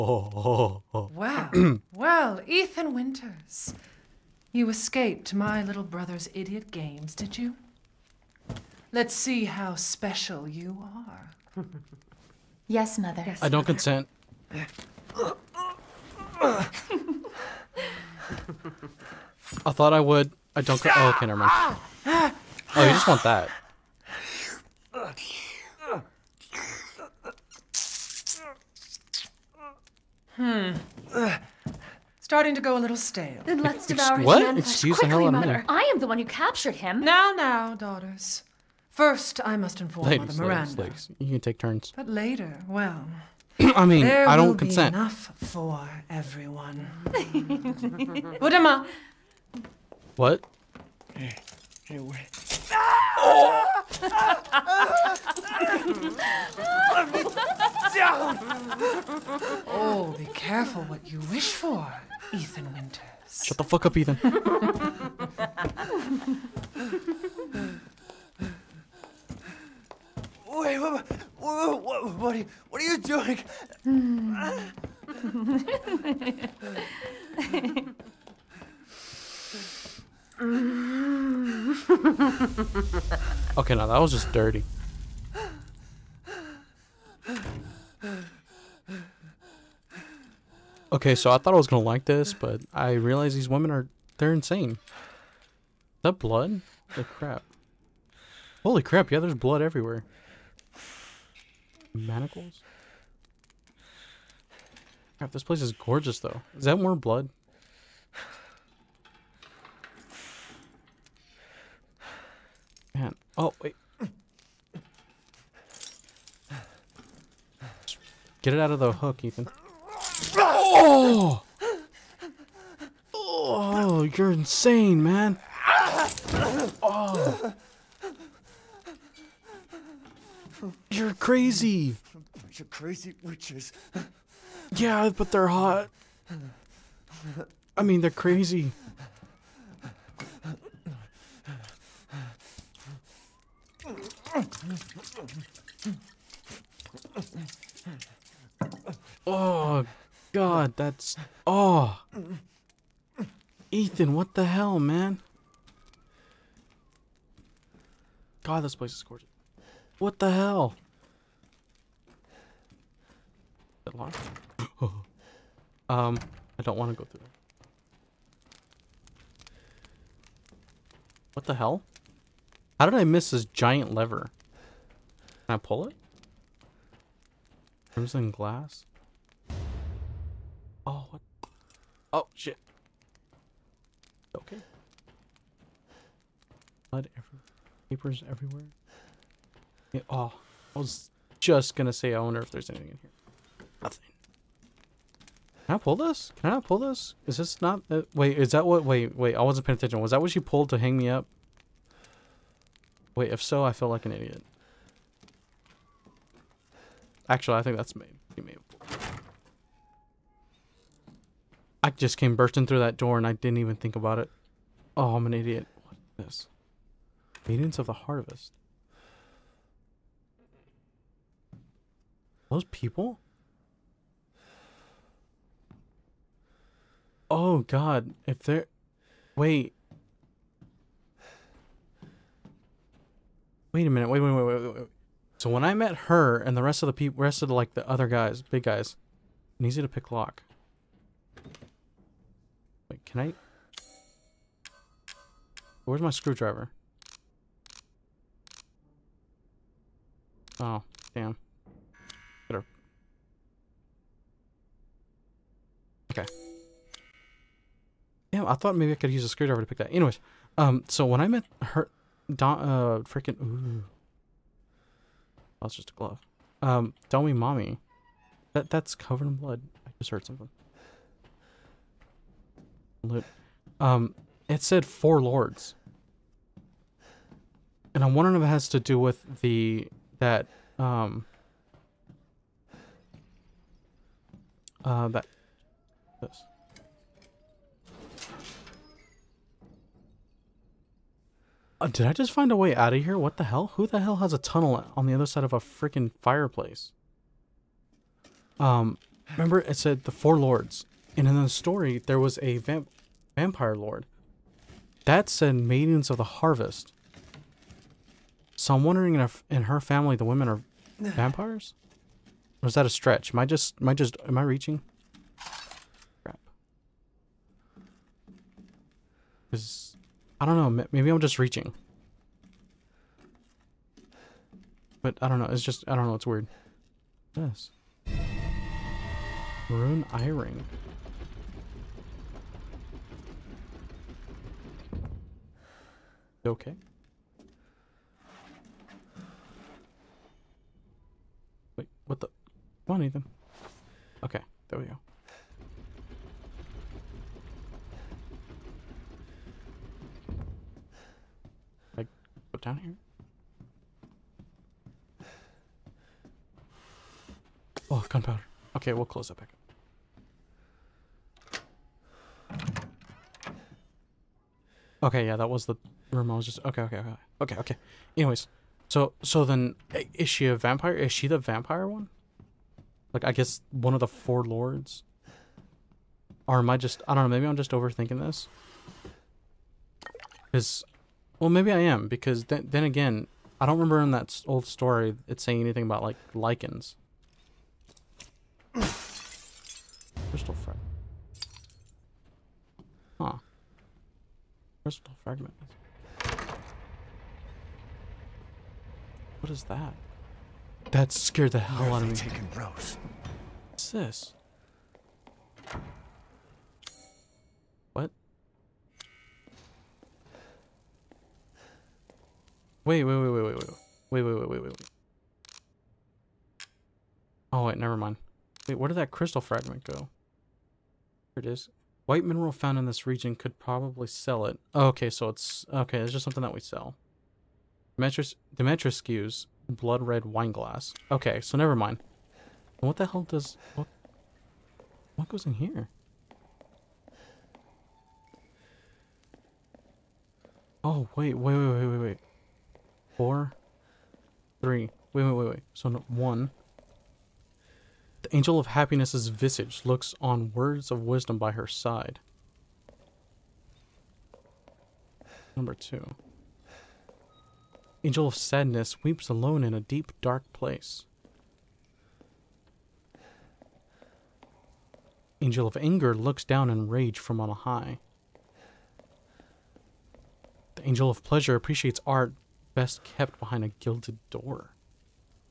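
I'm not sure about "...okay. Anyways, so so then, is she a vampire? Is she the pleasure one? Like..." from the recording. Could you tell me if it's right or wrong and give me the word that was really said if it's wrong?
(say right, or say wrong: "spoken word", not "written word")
wrong: "vampire", not "pleasure".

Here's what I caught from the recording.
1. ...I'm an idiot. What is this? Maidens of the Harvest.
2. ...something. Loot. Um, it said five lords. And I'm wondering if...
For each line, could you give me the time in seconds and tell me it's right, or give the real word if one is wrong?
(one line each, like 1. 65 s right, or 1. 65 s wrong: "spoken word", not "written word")
1. 215 s right
2. 270 s wrong: "four", not "five".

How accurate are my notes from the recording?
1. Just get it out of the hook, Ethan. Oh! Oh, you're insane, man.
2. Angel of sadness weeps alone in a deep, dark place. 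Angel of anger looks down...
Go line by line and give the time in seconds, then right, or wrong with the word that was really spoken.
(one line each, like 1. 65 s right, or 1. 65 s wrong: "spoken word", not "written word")
1. 117 s right
2. 458 s right.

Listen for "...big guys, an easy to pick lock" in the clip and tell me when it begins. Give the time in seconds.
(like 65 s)
238 s.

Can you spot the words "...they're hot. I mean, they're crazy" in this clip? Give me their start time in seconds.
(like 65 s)
135 s.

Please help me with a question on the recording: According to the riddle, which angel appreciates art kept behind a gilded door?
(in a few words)
angel of pleasure.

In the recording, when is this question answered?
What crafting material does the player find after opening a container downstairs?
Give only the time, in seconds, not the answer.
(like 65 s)
358 s.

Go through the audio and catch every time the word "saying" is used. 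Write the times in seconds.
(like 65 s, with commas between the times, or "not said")
385 s.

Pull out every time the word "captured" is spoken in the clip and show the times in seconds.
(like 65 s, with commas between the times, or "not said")
36 s.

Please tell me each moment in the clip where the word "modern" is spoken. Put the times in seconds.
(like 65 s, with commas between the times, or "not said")
not said.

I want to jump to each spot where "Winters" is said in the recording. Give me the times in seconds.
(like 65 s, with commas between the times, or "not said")
2 s, 62 s.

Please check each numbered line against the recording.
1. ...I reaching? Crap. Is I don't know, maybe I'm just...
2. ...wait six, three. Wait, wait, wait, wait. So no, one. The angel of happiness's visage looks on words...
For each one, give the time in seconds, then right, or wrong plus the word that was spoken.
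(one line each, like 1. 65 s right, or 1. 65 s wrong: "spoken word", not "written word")
1. 314 s right
2. 441 s wrong: "four", not "six".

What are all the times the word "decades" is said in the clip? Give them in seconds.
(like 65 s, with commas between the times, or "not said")
not said.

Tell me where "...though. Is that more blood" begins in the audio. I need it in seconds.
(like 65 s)
106 s.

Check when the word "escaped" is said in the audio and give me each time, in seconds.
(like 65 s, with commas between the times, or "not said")
4 s.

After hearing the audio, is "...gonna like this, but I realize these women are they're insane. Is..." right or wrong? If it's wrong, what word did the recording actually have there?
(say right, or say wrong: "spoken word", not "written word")
right.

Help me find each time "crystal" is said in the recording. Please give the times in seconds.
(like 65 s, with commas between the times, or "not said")
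390 s, 394 s, 419 s.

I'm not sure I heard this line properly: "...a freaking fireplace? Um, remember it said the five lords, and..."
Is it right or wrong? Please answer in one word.
wrong.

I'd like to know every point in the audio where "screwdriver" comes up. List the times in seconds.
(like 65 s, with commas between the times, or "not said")
246 s, 259 s.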